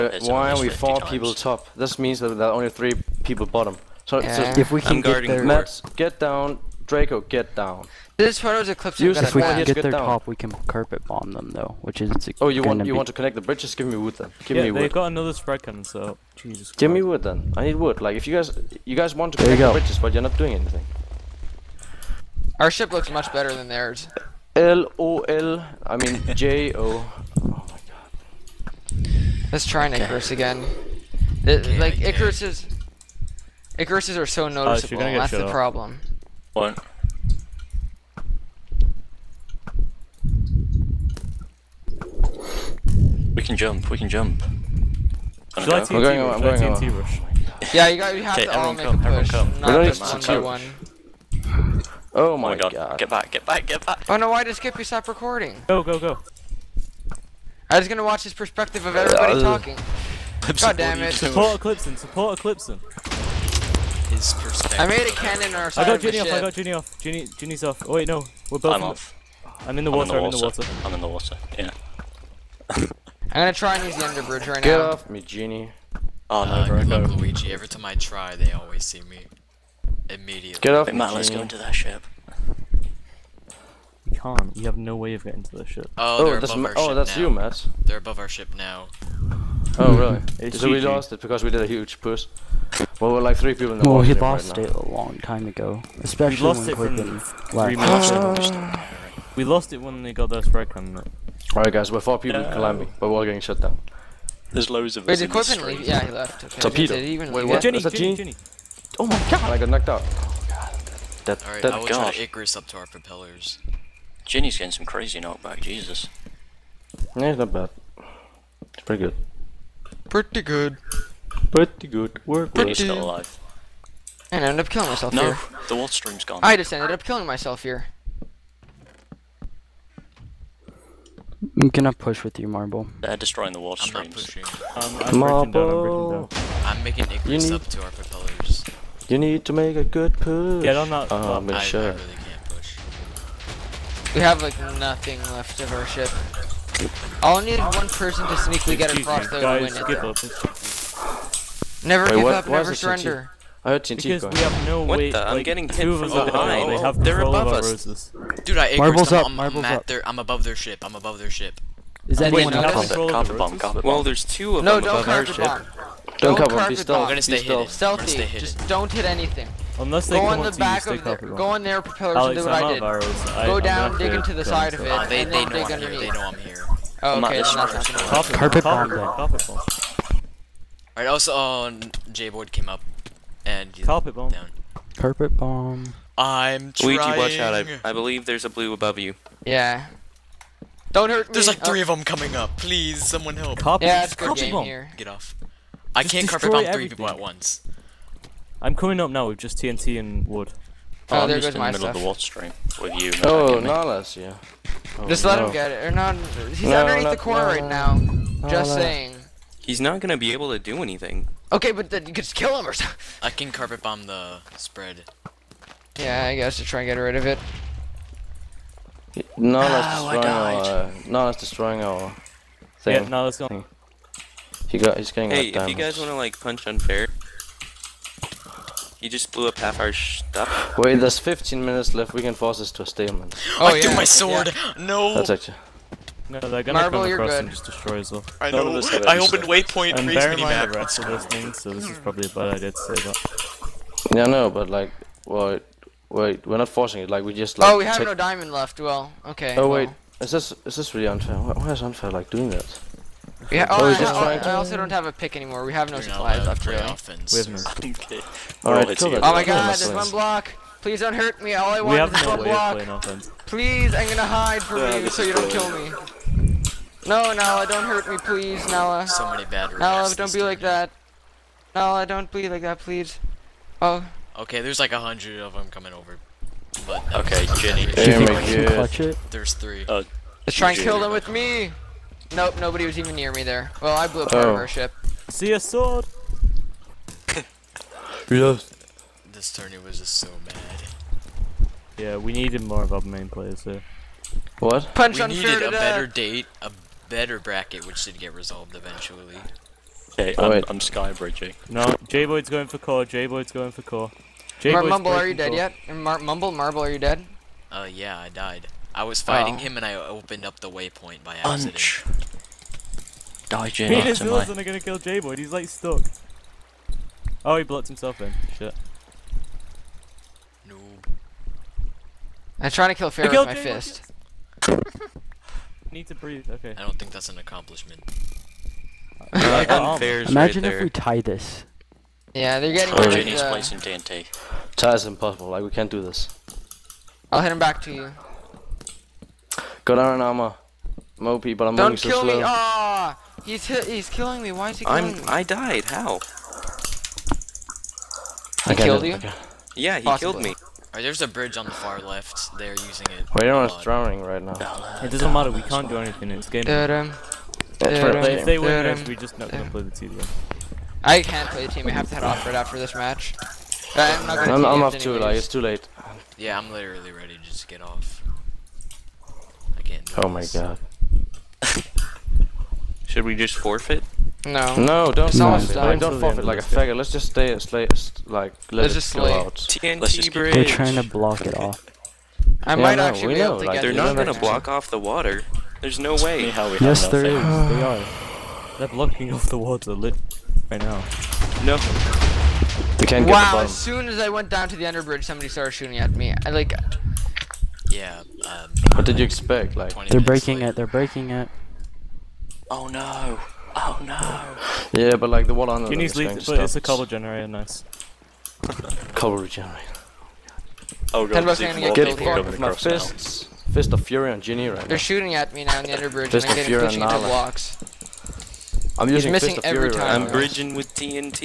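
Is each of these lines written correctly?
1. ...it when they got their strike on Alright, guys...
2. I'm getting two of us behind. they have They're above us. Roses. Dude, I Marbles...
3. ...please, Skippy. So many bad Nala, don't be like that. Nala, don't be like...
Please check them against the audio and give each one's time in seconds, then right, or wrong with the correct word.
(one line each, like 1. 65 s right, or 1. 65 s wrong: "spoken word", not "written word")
1. 99 s right
2. 155 s right
3. 268 s wrong: "Nala", not "Skippy".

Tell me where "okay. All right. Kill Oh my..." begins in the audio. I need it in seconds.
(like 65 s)
258 s.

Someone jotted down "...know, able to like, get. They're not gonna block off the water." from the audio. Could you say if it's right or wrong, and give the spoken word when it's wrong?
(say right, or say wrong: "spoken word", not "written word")
right.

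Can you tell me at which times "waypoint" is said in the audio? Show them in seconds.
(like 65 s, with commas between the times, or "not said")
239 s, 310 s.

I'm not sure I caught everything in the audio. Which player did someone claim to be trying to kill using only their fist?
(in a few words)
Pharaoh.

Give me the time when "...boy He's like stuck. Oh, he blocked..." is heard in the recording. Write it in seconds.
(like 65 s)
315 s.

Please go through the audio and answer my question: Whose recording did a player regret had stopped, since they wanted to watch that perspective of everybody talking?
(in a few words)
Skippy.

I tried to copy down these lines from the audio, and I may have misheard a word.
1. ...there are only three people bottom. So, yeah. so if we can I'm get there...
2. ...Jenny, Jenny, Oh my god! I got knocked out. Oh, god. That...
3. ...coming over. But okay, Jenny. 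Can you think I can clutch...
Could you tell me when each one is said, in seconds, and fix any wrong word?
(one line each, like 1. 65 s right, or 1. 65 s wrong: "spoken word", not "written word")
1. 2 s right
2. 107 s right
3. 275 s right.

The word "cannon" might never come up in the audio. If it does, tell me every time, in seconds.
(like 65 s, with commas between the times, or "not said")
15 s, 65 s.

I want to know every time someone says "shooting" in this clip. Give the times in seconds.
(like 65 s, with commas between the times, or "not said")
395 s, 414 s.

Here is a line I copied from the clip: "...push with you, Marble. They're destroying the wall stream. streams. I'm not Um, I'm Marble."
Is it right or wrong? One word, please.
right.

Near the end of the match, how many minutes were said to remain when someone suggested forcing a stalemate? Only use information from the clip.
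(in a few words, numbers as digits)
15.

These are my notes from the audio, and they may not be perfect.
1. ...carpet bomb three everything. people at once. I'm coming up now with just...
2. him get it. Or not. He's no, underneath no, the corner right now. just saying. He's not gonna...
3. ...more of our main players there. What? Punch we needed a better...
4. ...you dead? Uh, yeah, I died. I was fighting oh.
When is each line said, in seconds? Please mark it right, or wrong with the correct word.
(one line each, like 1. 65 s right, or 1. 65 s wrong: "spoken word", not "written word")
1. 196 s right
2. 205 s right
3. 292 s right
4. 306 s right.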